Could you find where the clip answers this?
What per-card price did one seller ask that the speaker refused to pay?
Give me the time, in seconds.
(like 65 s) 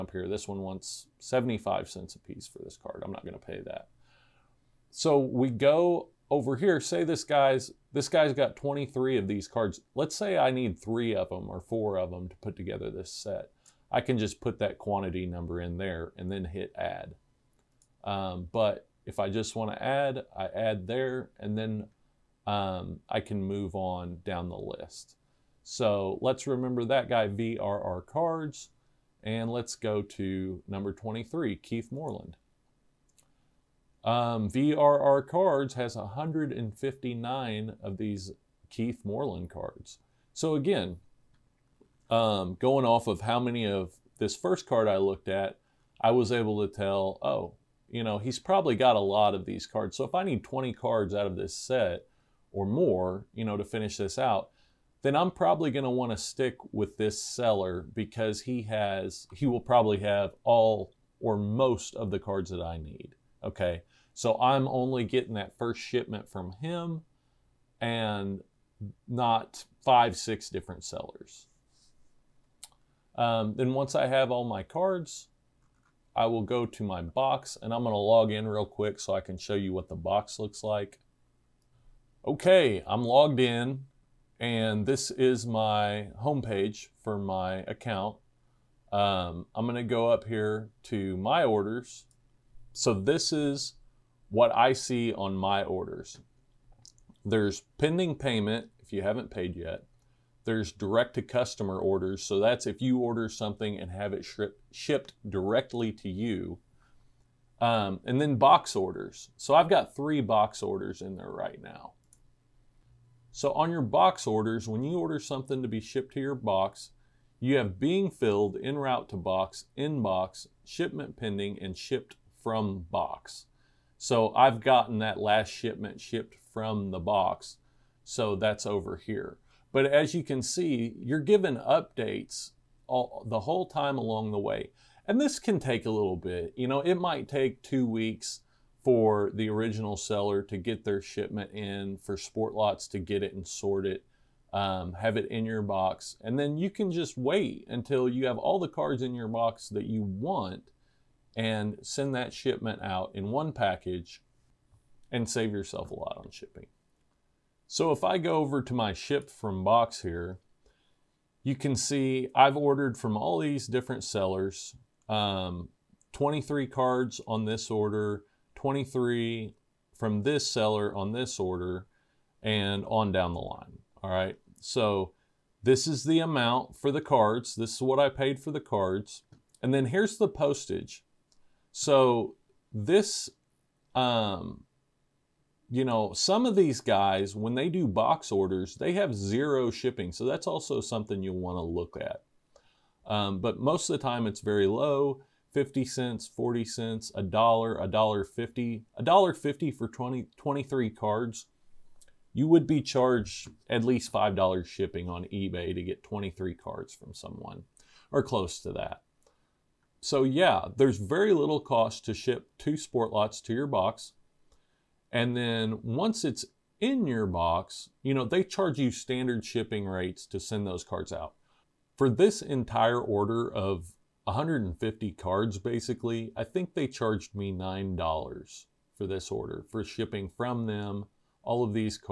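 1 s.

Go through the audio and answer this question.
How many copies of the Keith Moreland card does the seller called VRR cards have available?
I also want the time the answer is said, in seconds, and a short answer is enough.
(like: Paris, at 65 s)
159, at 35 s.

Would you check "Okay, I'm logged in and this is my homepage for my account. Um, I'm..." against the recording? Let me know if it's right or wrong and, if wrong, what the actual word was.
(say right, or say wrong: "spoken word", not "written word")
right.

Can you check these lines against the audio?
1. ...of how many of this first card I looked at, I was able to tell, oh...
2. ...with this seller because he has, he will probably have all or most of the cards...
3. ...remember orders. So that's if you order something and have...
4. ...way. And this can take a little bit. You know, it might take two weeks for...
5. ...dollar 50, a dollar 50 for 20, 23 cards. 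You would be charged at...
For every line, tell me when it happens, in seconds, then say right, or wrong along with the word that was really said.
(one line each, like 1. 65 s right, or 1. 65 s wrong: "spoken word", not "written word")
1. 43 s right
2. 56 s right
3. 101 s wrong: "customer", not "remember"
4. 134 s right
5. 197 s right.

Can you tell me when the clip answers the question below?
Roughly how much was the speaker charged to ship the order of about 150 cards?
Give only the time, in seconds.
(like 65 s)
227 s.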